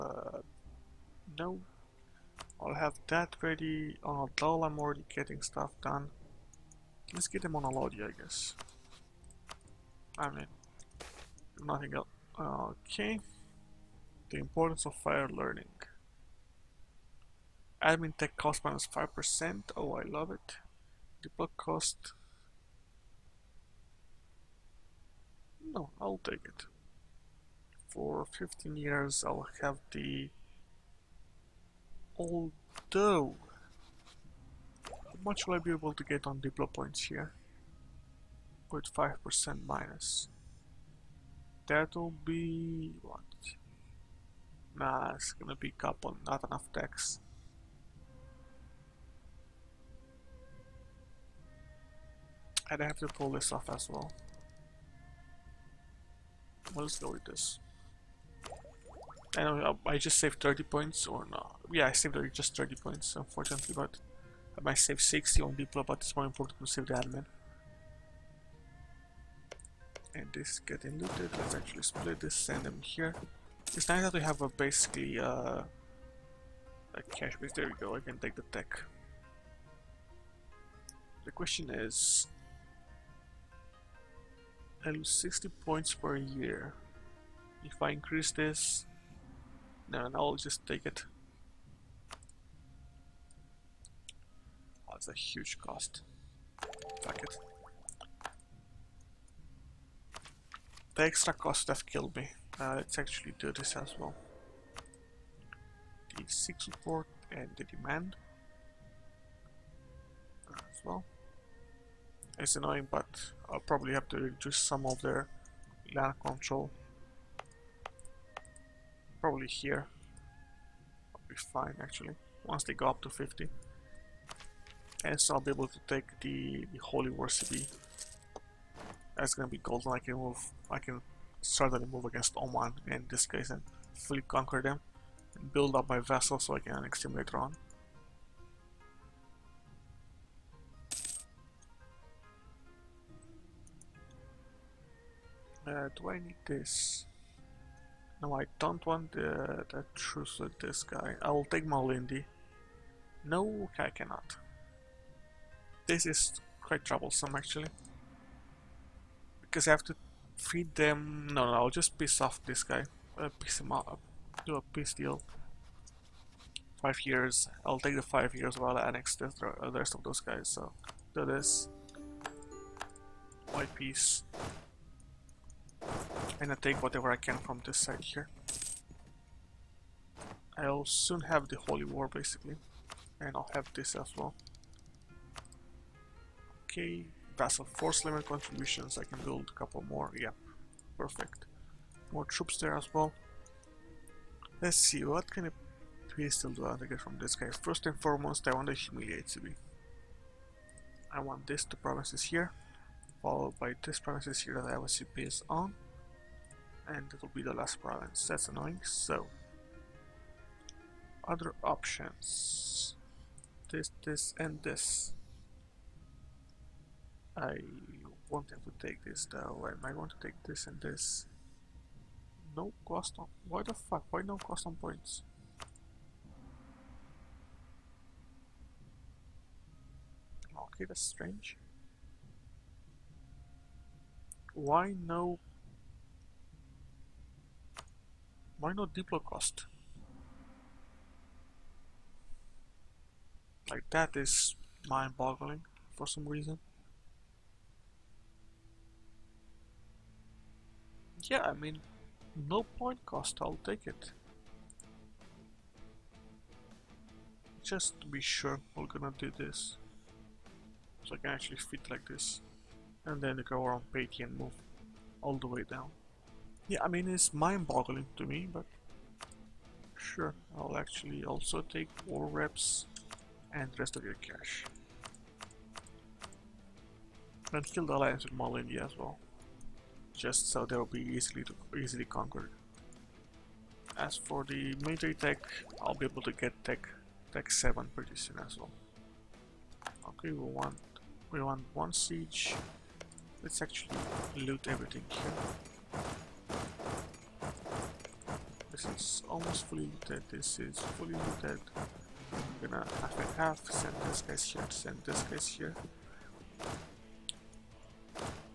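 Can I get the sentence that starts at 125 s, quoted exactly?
And so I'll be able to take the, the holy city That's gonna be golden.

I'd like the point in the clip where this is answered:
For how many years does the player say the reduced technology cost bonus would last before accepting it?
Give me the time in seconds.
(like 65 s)
28 s.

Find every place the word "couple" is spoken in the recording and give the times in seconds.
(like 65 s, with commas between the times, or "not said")
45 s, 189 s.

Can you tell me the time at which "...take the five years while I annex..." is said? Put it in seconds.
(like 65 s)
167 s.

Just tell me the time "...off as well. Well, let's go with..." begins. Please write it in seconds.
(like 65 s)
53 s.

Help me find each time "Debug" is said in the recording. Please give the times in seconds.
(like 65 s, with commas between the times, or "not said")
21 s.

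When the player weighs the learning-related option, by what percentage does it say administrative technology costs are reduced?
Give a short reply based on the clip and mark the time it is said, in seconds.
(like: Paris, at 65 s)
5%, at 18 s.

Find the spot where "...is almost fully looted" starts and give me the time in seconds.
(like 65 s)
299 s.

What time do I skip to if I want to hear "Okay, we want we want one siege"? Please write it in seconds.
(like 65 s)
290 s.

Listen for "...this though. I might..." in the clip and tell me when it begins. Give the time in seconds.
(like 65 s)
219 s.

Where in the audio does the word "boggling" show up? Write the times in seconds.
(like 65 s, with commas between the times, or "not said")
244 s, 267 s.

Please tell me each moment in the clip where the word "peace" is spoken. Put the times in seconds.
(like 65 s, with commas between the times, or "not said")
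164 s, 173 s.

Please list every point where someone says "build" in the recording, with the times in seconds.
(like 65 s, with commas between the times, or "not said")
135 s, 189 s.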